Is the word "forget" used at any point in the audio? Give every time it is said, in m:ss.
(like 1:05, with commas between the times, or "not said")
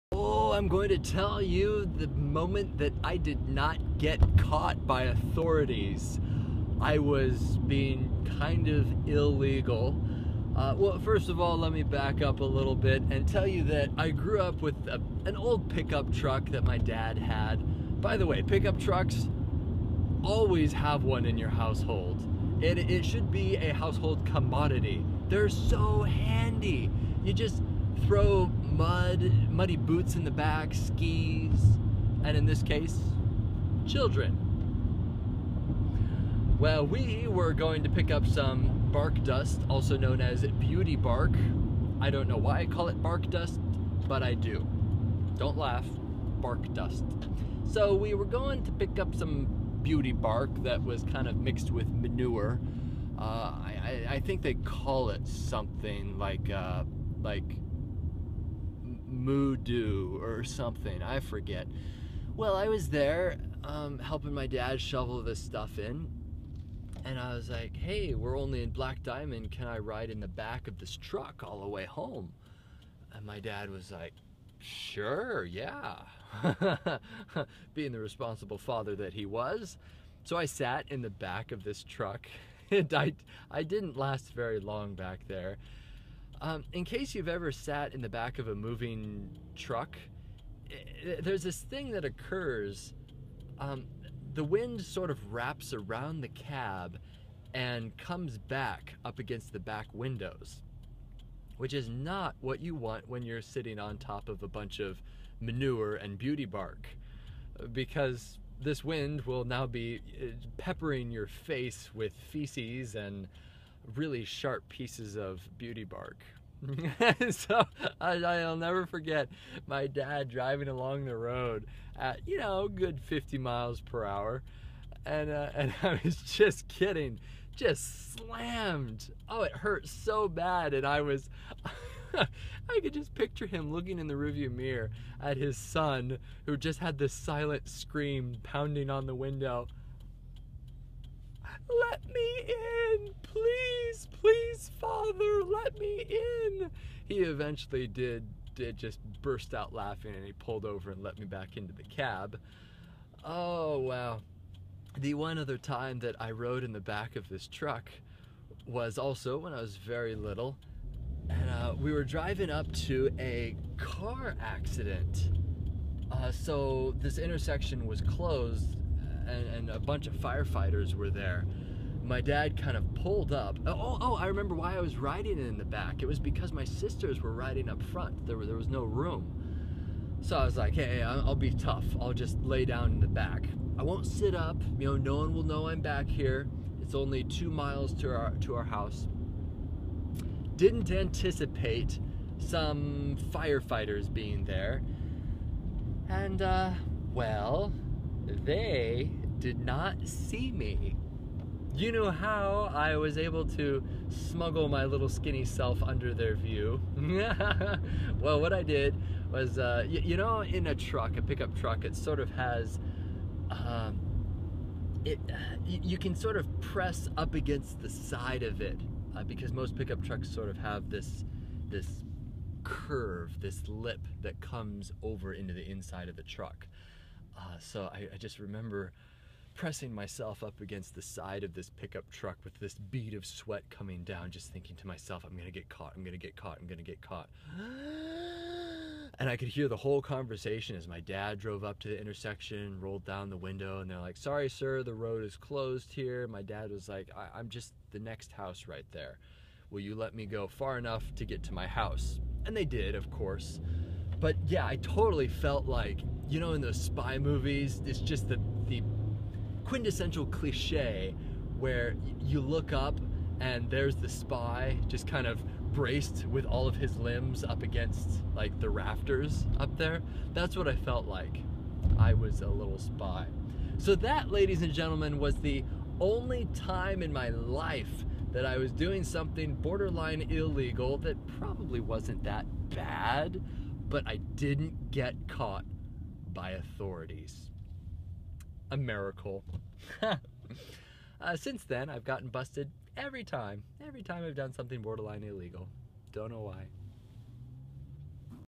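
1:01, 1:58.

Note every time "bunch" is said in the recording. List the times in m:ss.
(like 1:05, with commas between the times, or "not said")
1:44, 2:49.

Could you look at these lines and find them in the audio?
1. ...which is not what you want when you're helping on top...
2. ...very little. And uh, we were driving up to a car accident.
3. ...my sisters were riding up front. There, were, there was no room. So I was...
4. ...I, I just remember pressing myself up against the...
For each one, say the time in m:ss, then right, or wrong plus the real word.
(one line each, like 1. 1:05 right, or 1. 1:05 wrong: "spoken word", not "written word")
1. 1:41 wrong: "sitting", not "helping"
2. 2:39 right
3. 2:56 right
4. 3:47 right.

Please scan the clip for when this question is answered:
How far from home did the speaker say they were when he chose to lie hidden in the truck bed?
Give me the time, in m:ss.
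3:07.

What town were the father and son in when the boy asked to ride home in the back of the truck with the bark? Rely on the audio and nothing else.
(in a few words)
Black Diamond.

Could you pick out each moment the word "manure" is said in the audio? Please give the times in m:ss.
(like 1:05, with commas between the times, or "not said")
0:51, 1:45.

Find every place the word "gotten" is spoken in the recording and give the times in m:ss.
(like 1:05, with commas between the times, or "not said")
4:52.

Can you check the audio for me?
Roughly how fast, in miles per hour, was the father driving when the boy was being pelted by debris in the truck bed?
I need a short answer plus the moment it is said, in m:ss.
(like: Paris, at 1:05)
50, at 2:03.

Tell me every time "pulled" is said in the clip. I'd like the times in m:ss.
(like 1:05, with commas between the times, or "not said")
2:30, 2:52.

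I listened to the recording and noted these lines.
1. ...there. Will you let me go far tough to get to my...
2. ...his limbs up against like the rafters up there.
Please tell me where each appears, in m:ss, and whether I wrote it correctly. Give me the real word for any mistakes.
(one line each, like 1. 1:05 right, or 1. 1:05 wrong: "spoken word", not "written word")
1. 4:08 wrong: "enough", not "tough"
2. 4:26 right.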